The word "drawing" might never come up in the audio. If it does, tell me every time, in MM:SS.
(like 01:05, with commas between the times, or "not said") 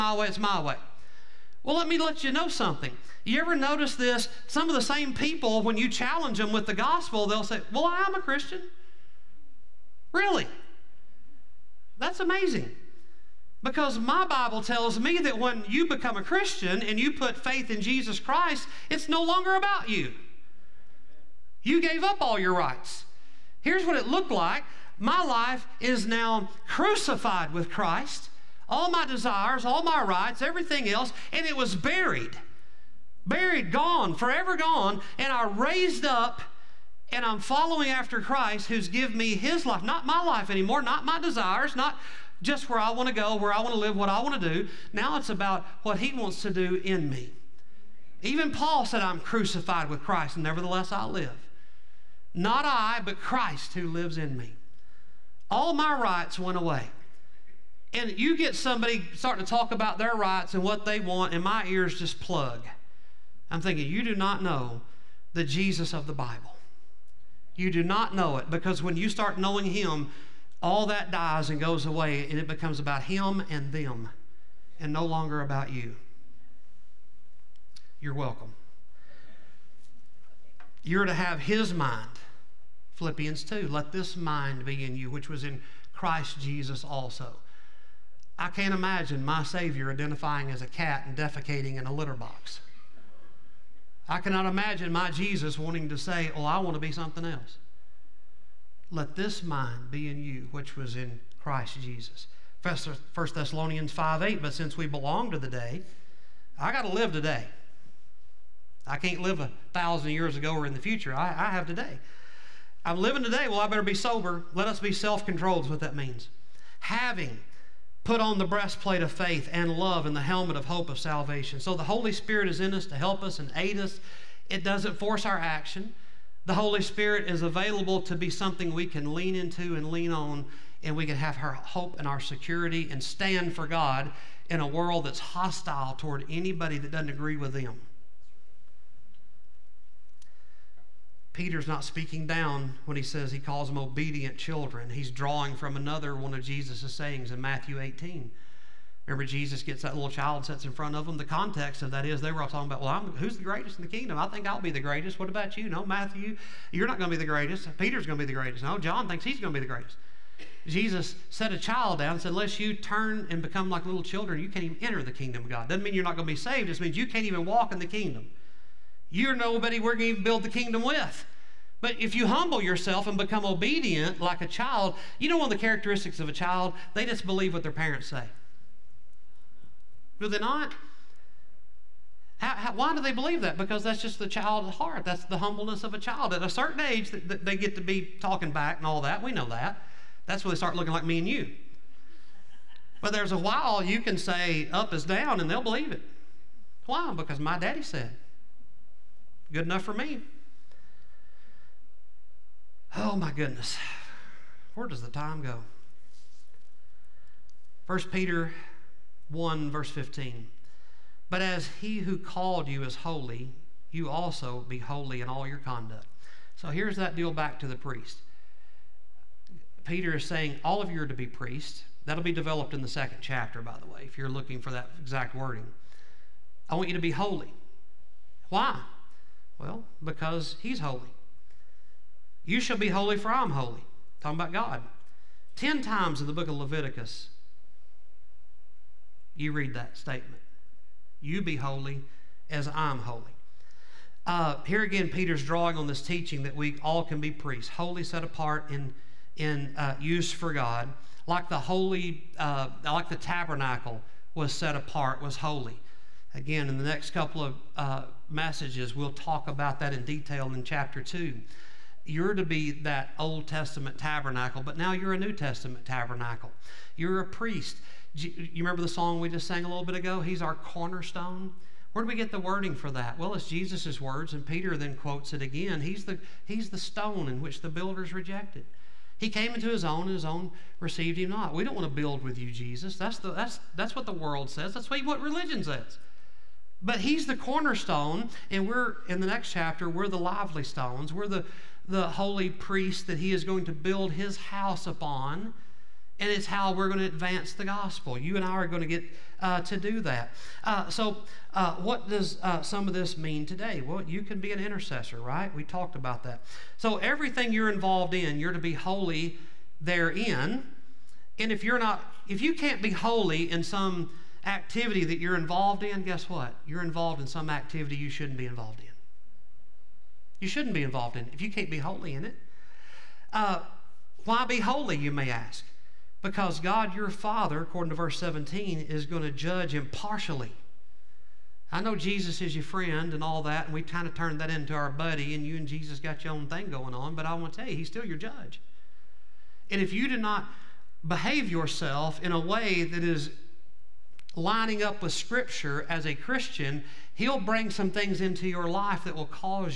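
02:25, 04:05.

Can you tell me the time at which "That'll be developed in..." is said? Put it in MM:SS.
03:42.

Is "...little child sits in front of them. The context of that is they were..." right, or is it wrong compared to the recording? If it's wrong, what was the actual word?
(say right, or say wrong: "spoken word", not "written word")
right.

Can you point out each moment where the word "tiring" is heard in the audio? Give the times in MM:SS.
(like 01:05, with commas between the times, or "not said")
not said.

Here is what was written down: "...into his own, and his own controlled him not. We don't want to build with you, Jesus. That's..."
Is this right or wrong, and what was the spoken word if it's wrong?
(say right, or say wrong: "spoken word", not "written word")
wrong: "received", not "controlled".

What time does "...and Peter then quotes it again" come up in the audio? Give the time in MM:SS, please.
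04:34.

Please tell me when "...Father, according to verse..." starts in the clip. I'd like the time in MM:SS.
05:27.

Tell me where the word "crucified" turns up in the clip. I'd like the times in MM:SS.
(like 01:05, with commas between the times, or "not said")
00:26, 00:49.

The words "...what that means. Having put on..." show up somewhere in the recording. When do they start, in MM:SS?
01:55.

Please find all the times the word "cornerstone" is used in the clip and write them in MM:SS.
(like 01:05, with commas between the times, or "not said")
04:30, 04:47.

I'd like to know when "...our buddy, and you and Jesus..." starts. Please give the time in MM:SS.
05:34.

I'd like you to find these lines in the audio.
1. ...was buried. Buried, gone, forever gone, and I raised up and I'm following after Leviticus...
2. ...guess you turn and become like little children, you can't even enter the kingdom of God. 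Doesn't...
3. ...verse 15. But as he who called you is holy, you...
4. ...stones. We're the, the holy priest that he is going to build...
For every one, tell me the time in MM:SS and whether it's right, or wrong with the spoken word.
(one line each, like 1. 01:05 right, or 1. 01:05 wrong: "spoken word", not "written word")
1. 00:31 wrong: "Christ", not "Leviticus"
2. 02:42 wrong: "unless", not "guess"
3. 03:29 right
4. 04:50 right.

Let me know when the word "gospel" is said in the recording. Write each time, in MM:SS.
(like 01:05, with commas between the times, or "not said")
00:06, 04:57.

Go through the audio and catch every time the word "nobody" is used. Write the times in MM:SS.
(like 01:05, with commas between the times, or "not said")
02:49.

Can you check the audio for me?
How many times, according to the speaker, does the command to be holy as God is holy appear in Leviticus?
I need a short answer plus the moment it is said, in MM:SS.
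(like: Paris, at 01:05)
10, at 03:55.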